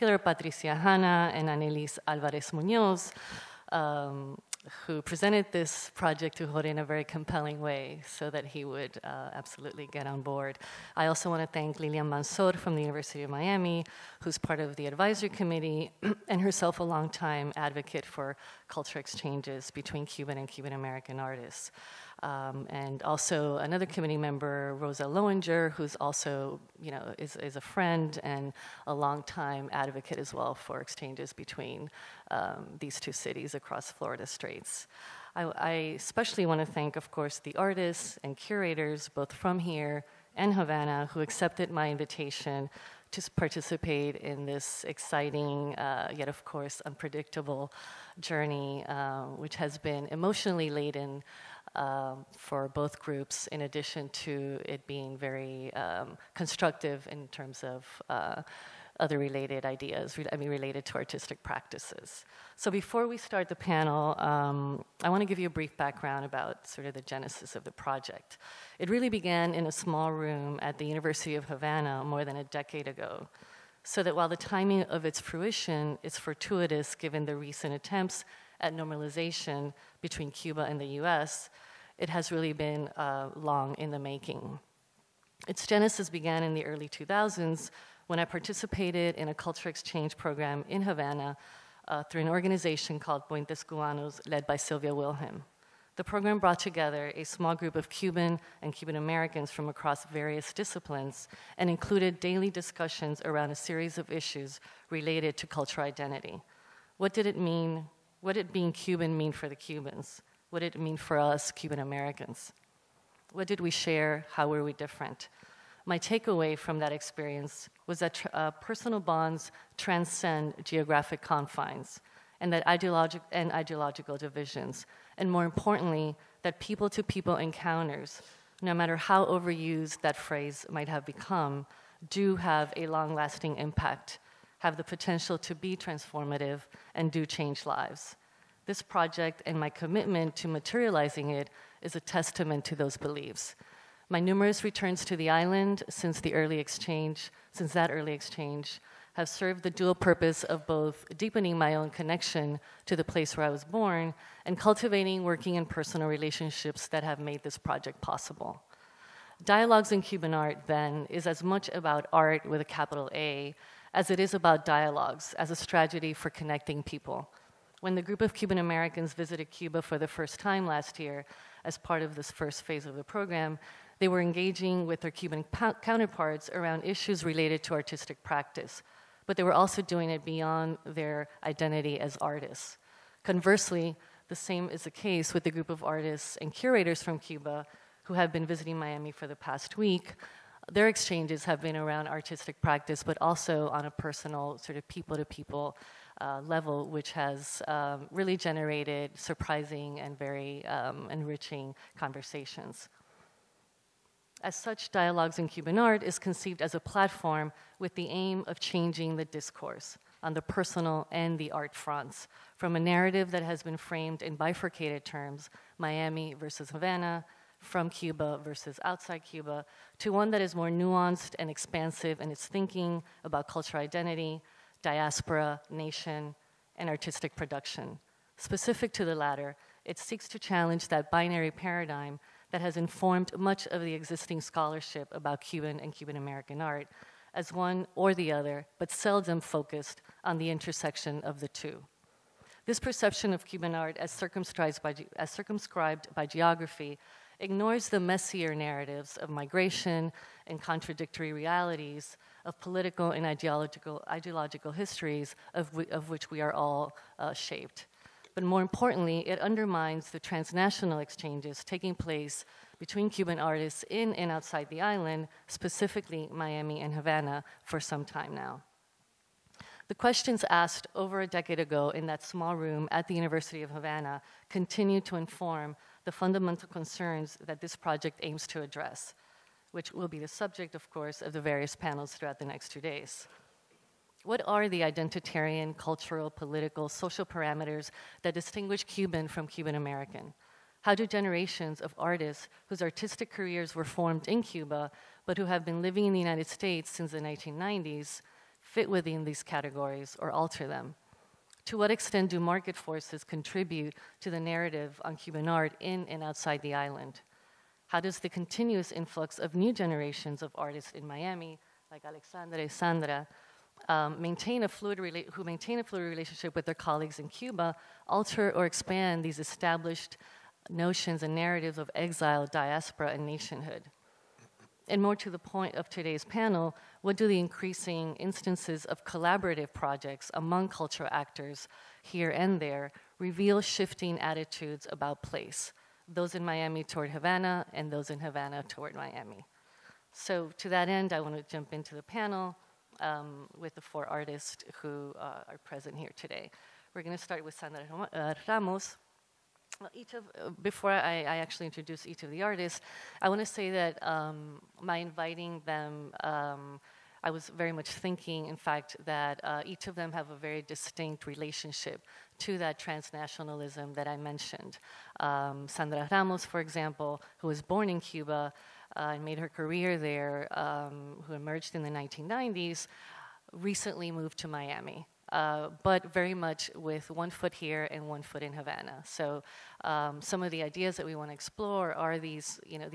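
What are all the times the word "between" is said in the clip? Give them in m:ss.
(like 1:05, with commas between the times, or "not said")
0:19, 0:31, 1:19, 4:22.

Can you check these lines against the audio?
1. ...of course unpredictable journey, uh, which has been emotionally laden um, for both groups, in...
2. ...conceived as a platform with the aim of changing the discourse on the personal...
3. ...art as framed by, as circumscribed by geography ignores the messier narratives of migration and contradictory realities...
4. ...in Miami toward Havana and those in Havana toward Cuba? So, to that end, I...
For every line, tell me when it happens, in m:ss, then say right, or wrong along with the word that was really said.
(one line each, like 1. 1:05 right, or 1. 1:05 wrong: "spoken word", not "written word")
1. 0:46 right
2. 3:26 right
3. 4:03 wrong: "circumscribed", not "framed"
4. 5:36 wrong: "Miami", not "Cuba".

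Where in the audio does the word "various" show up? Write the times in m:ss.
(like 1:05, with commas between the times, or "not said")
1:40, 4:41.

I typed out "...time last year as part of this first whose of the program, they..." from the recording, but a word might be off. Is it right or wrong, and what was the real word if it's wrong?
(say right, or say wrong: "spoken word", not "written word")
wrong: "phase", not "whose".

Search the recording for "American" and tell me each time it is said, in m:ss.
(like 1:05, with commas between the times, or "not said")
0:20, 1:38, 1:51, 2:48, 3:56, 4:49.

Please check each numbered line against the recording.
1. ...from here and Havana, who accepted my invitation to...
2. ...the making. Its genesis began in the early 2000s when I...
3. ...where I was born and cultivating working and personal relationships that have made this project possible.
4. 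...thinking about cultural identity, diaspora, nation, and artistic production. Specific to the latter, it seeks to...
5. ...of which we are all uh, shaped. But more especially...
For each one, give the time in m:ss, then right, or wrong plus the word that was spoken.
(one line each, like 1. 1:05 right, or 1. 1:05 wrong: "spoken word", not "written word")
1. 0:39 right
2. 1:23 right
3. 2:33 right
4. 3:42 right
5. 4:15 wrong: "importantly", not "especially".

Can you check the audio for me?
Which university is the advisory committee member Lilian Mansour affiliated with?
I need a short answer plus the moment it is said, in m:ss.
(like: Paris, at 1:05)
University of Miami, at 0:12.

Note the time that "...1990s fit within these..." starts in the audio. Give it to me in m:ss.
4:57.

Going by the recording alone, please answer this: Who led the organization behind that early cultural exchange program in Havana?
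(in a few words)
Sylvia Wilhelm.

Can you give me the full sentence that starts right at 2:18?
This project and my commitment to materializing it is a testament to those beliefs.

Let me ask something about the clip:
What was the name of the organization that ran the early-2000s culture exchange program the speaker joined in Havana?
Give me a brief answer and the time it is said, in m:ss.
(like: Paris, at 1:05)
Puentes Cubanos, at 1:33.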